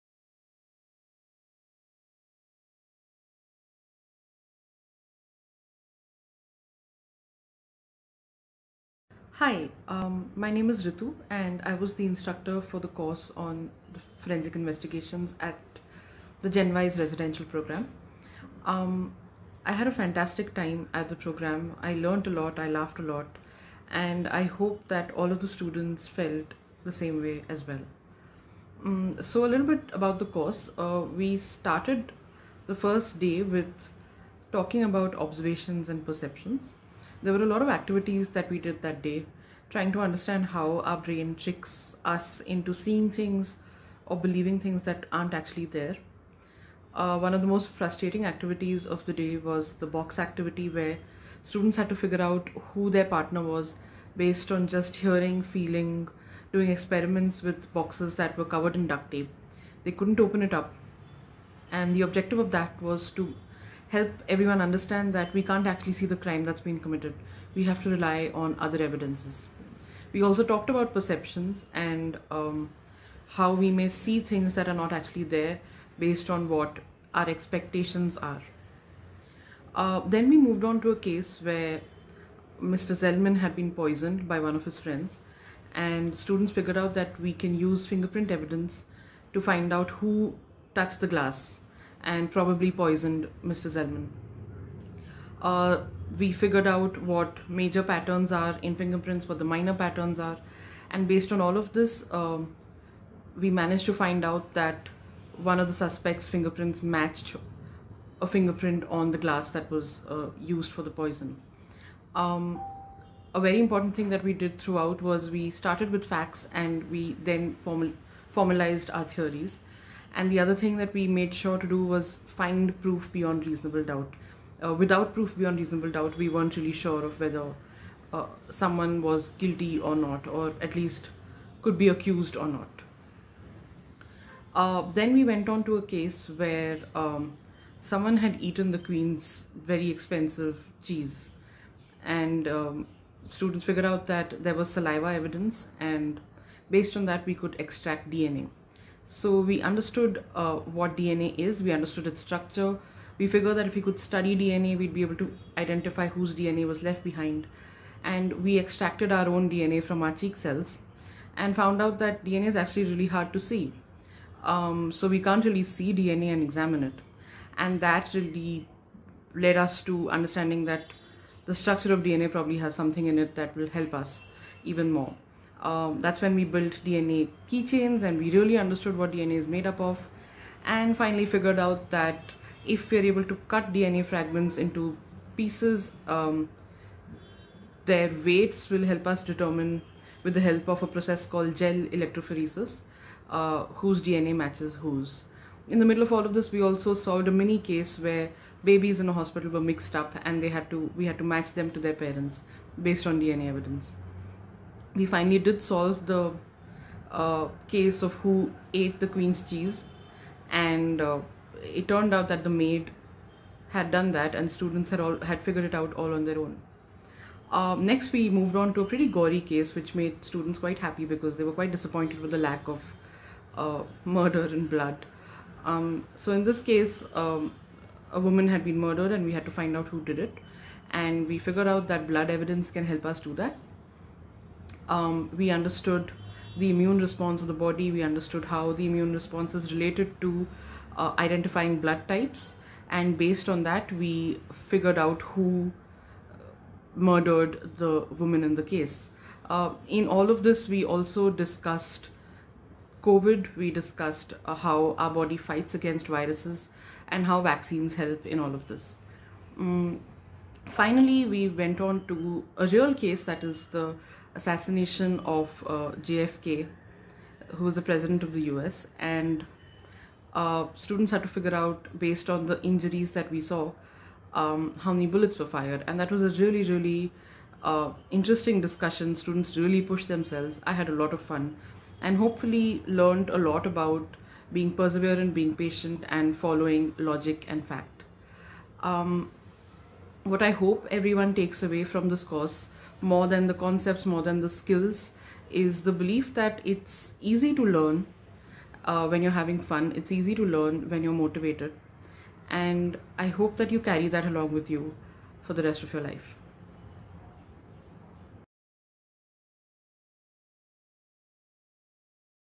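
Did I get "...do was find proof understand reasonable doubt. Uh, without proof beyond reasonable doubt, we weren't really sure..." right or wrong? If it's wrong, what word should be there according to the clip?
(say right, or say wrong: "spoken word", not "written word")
wrong: "beyond", not "understand".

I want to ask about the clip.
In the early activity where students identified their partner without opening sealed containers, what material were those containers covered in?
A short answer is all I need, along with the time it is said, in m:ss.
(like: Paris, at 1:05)
duct tape, at 0:58.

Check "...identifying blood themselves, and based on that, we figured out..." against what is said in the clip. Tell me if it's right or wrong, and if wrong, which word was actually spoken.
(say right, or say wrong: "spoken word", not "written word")
wrong: "types", not "themselves".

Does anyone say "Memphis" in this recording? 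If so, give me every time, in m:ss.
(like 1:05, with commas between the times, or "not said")
not said.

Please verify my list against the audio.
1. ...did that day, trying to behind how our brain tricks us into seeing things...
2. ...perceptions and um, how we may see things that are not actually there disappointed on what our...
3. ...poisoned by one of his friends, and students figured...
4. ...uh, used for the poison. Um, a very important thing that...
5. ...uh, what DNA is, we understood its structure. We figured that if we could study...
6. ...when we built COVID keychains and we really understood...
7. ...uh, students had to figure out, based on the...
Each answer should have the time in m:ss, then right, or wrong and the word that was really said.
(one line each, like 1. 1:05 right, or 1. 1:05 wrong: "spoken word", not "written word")
1. 0:38 wrong: "understand", not "behind"
2. 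1:10 wrong: "based", not "disappointed"
3. 1:23 right
4. 1:50 right
5. 2:30 right
6. 2:56 wrong: "DNA", not "COVID"
7. 4:30 right.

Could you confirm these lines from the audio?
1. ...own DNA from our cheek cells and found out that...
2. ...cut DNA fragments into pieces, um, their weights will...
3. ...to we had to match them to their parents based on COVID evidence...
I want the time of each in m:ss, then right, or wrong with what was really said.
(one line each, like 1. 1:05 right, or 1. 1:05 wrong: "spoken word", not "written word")
1. 2:39 right
2. 3:03 right
3. 3:20 wrong: "DNA", not "COVID".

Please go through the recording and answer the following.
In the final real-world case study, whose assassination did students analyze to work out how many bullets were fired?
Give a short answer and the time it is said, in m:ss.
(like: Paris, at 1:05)
JFK, at 4:26.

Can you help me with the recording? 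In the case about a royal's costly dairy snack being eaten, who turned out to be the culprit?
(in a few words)
The maid.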